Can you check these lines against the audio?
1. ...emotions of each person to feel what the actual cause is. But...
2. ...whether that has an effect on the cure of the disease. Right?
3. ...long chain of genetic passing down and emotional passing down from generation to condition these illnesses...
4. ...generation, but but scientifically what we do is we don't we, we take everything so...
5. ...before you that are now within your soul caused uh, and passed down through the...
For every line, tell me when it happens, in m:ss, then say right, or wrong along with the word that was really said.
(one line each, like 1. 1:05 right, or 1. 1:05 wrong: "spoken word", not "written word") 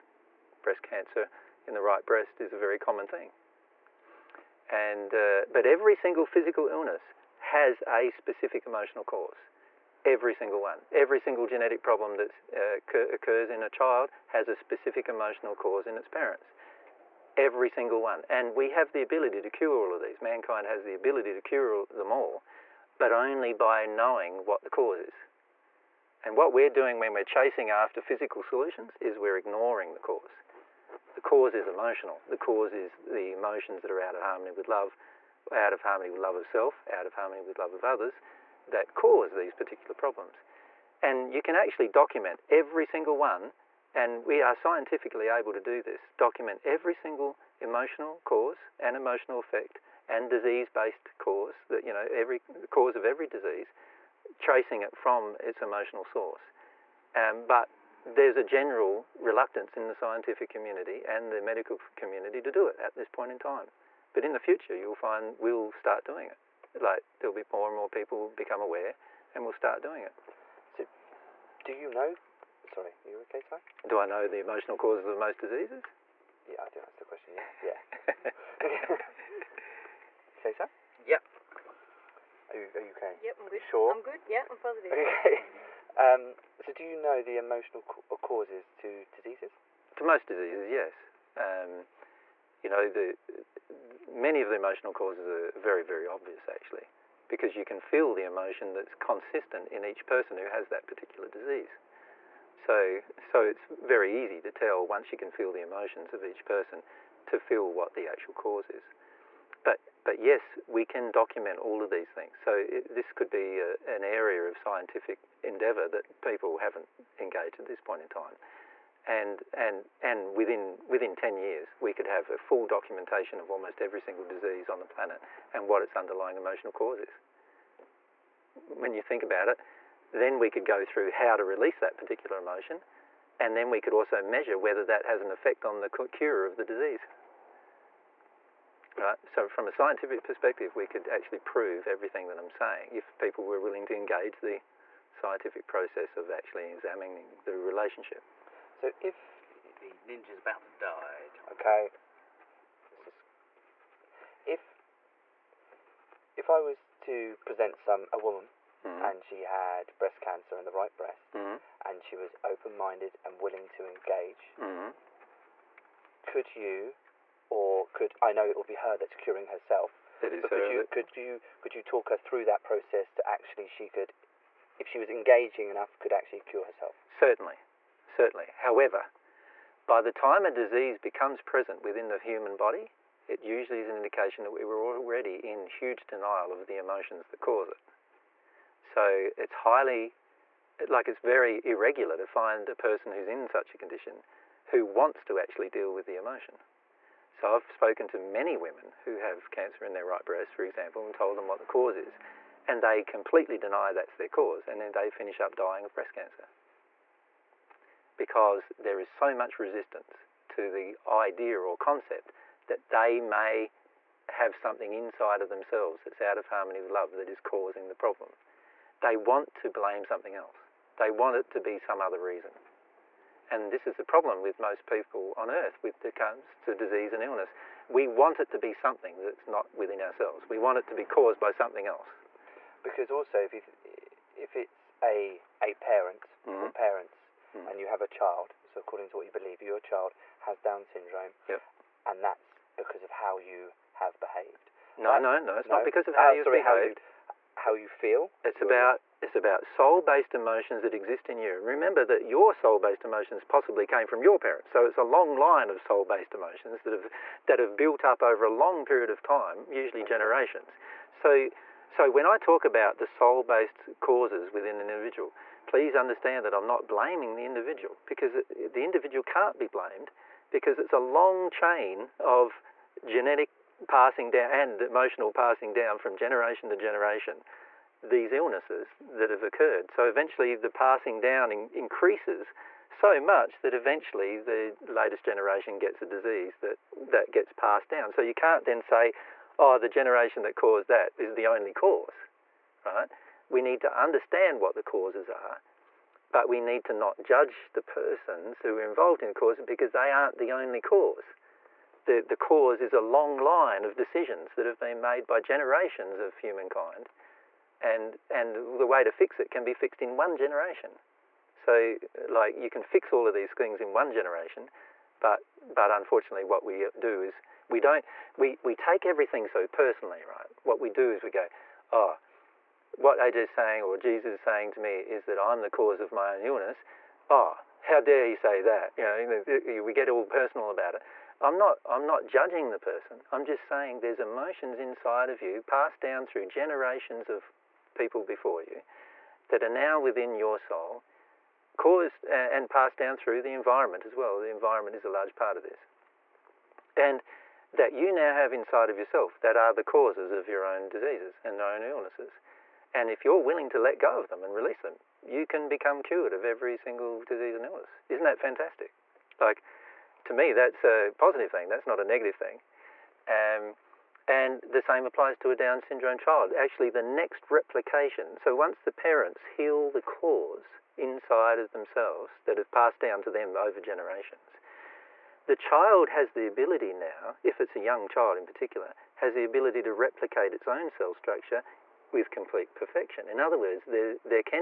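1. 1:45 right
2. 2:14 right
3. 4:30 wrong: "generation", not "condition"
4. 5:14 wrong: "unfortunately", not "scientifically"
5. 5:38 right.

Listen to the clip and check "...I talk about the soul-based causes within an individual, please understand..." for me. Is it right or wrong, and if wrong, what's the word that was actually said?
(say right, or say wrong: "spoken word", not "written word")
right.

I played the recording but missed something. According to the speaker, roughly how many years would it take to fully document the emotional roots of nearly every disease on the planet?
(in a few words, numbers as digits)
10.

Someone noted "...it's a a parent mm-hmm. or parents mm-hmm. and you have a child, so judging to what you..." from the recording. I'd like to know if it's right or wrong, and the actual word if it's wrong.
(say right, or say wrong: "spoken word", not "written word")
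wrong: "according", not "judging".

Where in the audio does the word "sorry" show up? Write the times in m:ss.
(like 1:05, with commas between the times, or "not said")
1:12, 4:06.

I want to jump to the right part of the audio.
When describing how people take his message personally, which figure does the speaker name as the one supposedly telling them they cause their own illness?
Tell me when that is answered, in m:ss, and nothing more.
5:23.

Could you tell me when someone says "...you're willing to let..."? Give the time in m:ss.
5:53.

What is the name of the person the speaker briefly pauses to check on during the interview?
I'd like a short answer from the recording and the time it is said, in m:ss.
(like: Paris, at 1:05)
Ty, at 1:13.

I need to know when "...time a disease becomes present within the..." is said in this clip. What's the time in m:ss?
3:00.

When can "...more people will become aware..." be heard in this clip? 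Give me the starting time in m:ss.
1:07.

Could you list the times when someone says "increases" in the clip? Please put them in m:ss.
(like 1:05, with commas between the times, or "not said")
4:41.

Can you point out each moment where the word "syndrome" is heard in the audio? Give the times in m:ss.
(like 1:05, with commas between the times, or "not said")
4:00, 6:05.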